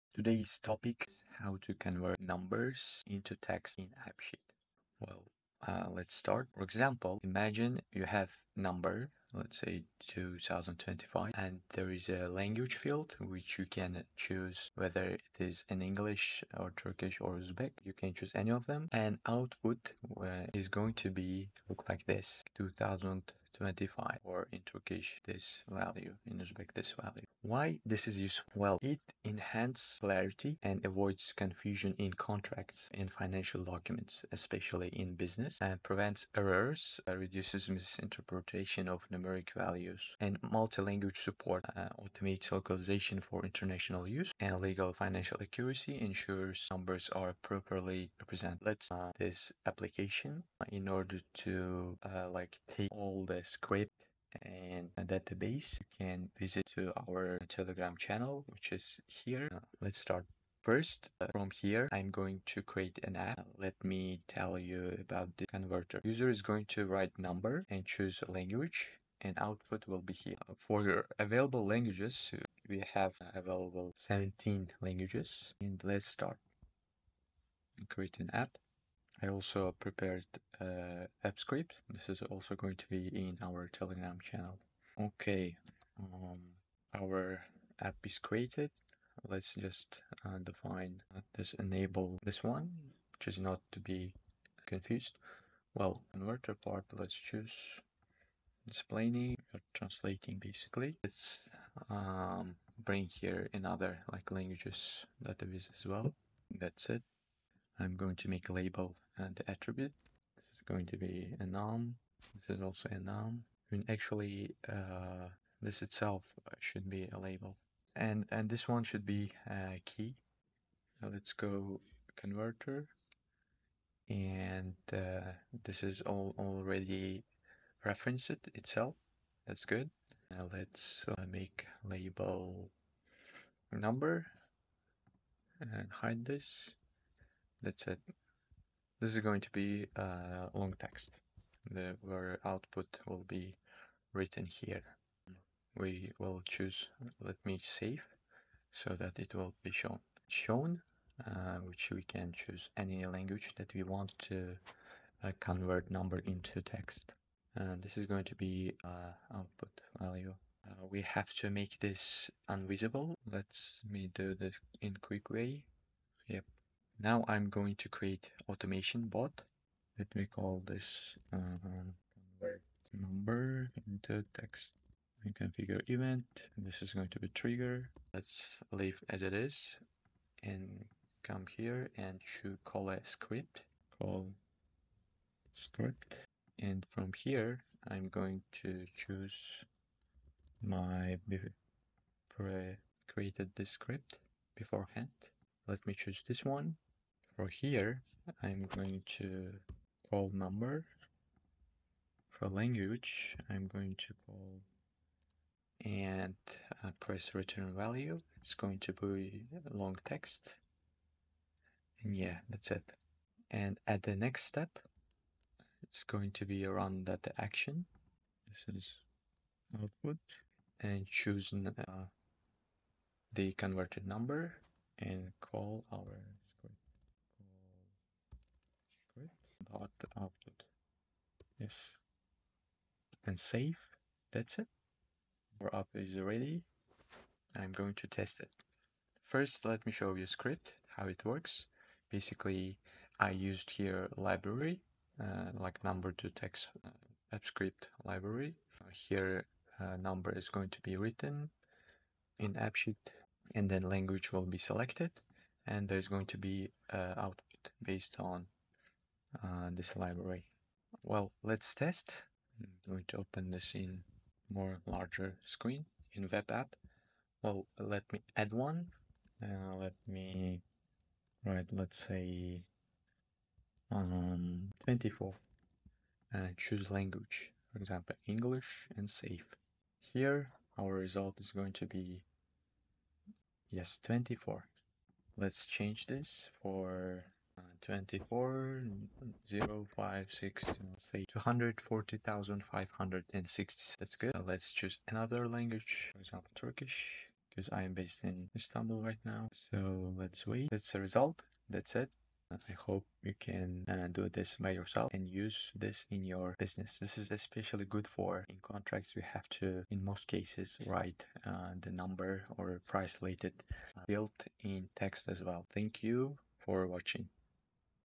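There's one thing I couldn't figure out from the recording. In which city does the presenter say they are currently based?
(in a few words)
Istanbul.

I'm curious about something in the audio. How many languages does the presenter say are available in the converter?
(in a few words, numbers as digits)
17.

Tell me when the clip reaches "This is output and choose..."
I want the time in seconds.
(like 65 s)
218 s.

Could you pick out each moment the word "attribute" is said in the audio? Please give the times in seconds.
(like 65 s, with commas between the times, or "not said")
109 s.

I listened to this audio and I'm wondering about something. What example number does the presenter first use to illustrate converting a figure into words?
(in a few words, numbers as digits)
2025.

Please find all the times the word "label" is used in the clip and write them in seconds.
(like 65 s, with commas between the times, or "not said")
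108 s, 117 s, 131 s.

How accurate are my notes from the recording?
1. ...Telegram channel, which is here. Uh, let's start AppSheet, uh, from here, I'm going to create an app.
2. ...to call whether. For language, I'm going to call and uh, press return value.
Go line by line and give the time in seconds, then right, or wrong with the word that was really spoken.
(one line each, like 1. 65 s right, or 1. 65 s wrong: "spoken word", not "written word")
1. 57 s wrong: "First", not "AppSheet"
2. 199 s wrong: "number", not "whether".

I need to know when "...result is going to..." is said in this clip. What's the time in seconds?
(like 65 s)
280 s.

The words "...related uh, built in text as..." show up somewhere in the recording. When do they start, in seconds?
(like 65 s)
313 s.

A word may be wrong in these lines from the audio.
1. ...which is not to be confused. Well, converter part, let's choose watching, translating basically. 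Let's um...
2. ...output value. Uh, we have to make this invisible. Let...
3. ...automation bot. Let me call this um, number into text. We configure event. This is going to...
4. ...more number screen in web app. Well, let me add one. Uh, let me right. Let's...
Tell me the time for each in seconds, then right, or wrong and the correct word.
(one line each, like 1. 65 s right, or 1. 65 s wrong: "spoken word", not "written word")
1. 93 s wrong: "explaining", not "watching"
2. 159 s right
3. 168 s right
4. 264 s wrong: "larger", not "number".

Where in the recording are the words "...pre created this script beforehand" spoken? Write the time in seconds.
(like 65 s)
192 s.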